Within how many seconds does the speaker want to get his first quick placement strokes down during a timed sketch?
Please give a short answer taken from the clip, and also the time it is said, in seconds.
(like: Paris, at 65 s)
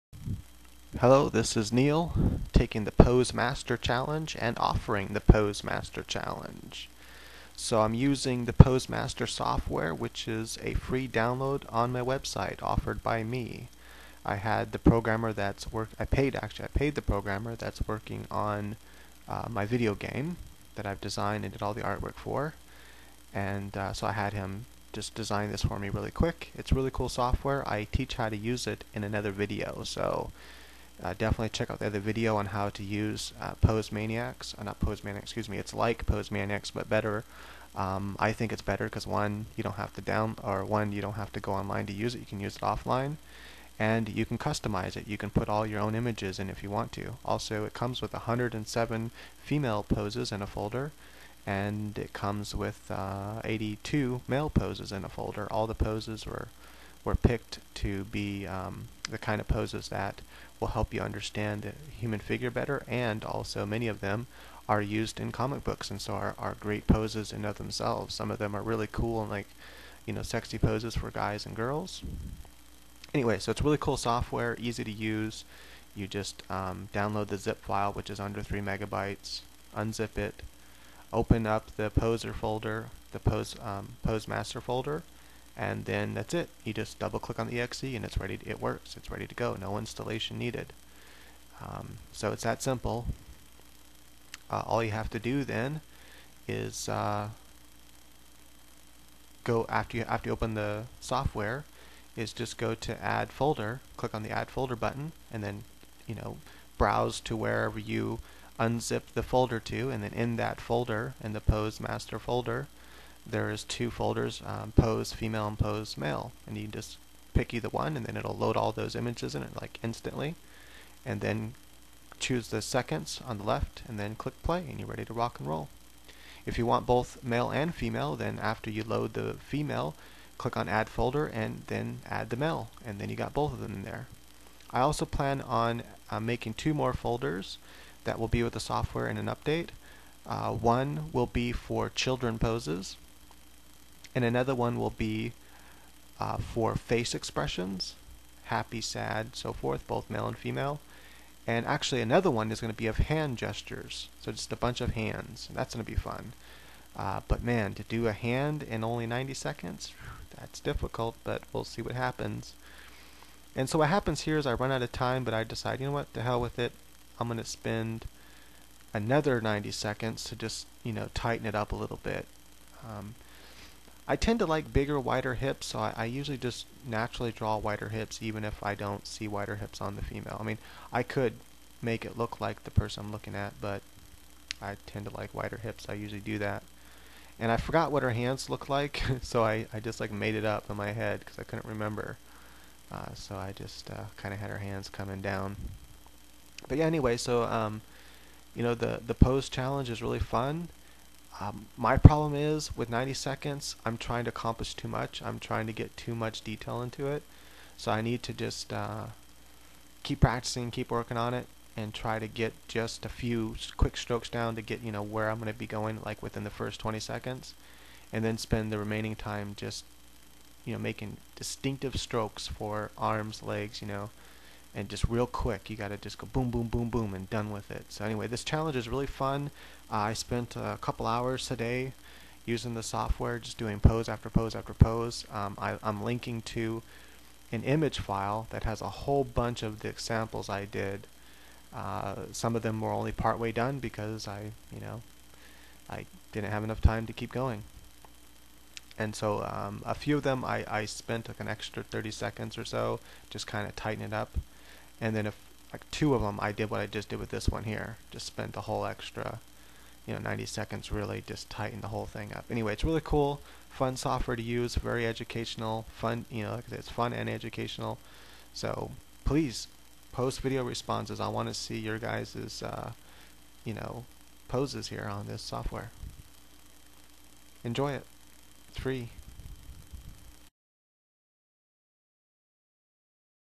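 20, at 216 s.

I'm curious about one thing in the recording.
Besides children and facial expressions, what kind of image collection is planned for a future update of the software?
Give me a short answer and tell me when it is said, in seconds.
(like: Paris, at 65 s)
hand gestures, at 152 s.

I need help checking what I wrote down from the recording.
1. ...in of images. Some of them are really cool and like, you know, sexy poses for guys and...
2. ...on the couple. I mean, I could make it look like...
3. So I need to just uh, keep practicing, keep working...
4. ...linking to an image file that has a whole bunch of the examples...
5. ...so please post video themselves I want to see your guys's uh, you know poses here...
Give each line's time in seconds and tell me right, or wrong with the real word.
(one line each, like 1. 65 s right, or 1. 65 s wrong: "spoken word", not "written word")
1. 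67 s wrong: "themselves", not "images"
2. 179 s wrong: "female", not "couple"
3. 207 s right
4. 236 s right
5. 268 s wrong: "responses", not "themselves".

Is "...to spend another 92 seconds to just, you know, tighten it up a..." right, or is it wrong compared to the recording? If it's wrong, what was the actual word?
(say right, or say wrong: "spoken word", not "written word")
wrong: "90", not "92".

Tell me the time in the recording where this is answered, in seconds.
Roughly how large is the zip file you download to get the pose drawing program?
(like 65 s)
78 s.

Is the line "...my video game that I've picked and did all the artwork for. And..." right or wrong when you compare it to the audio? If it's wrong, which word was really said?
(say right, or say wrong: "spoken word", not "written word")
wrong: "designed", not "picked".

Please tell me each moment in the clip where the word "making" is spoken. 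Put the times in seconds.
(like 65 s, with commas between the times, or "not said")
136 s, 220 s.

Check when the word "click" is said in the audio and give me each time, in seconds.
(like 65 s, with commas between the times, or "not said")
87 s, 103 s, 124 s, 130 s.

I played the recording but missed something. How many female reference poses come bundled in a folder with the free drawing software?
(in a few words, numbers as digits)
107.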